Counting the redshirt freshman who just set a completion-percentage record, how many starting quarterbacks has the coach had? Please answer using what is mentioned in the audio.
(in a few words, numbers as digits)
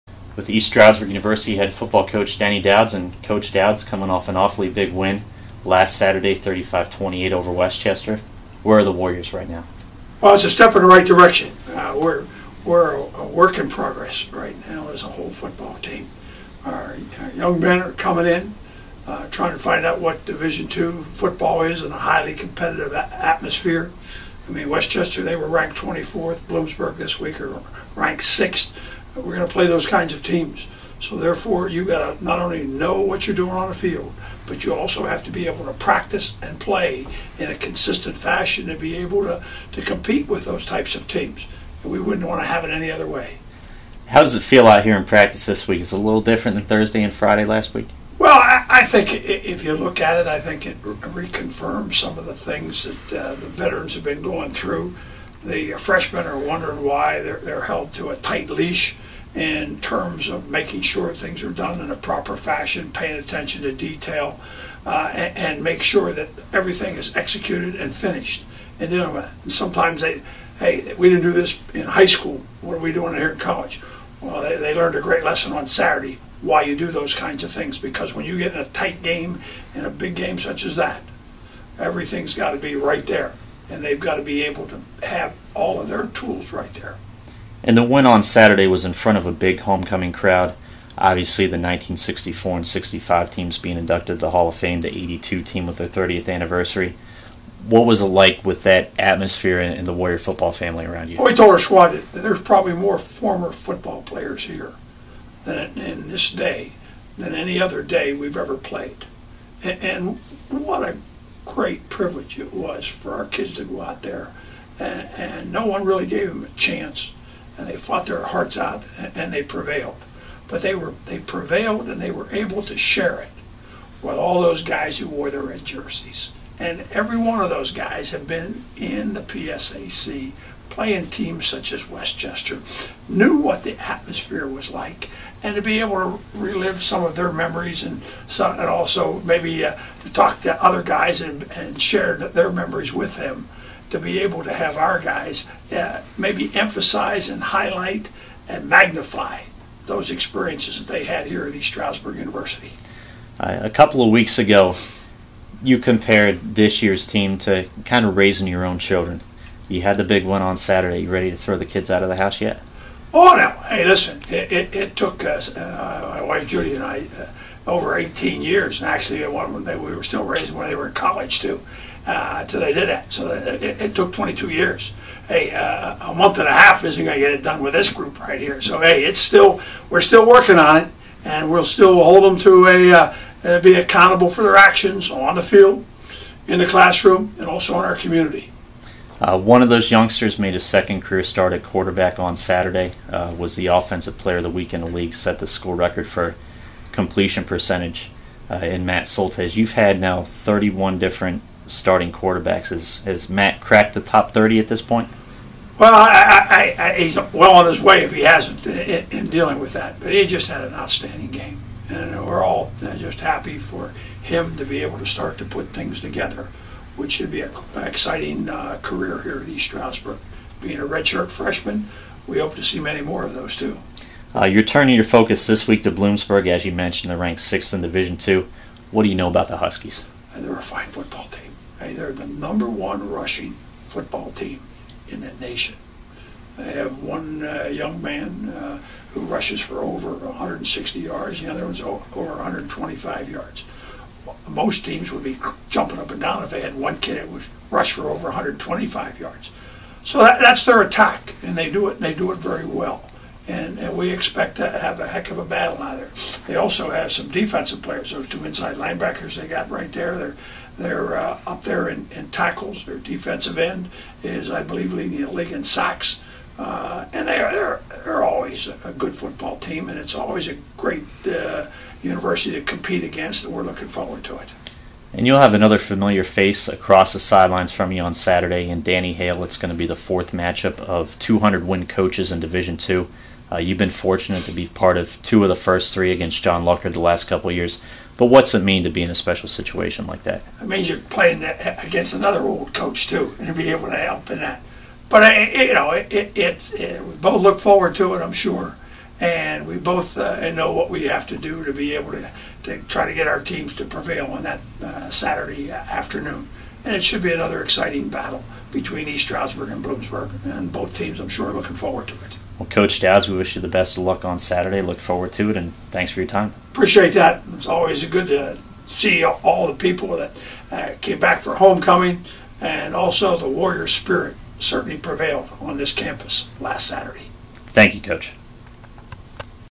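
31.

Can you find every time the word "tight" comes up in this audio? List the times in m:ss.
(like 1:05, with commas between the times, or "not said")
0:58, 1:18.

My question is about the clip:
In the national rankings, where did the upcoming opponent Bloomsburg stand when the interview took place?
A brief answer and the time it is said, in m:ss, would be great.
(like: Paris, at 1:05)
6th, at 0:27.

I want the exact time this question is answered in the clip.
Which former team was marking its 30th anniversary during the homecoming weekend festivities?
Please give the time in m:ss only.
1:34.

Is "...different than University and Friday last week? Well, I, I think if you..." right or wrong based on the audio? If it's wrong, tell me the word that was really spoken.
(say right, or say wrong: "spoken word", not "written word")
wrong: "Thursday", not "University".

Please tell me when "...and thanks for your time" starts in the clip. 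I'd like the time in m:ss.
5:15.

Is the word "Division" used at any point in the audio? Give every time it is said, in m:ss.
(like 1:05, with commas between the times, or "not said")
0:20, 3:47, 4:42.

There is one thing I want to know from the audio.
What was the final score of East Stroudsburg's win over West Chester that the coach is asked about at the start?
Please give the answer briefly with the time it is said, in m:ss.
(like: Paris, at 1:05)
35-28, at 0:06.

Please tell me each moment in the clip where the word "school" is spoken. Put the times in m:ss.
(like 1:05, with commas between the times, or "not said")
1:12, 3:15.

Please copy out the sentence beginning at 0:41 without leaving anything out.
And we wouldn't want to have it any other way.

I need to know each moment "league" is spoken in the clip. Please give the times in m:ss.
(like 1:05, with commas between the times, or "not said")
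3:14, 4:25.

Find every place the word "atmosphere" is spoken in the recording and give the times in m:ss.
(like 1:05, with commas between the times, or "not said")
0:22, 1:38, 2:13.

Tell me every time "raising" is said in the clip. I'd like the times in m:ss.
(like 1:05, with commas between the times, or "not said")
2:38, 2:50.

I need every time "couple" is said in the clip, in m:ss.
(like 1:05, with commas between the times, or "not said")
2:33, 4:47.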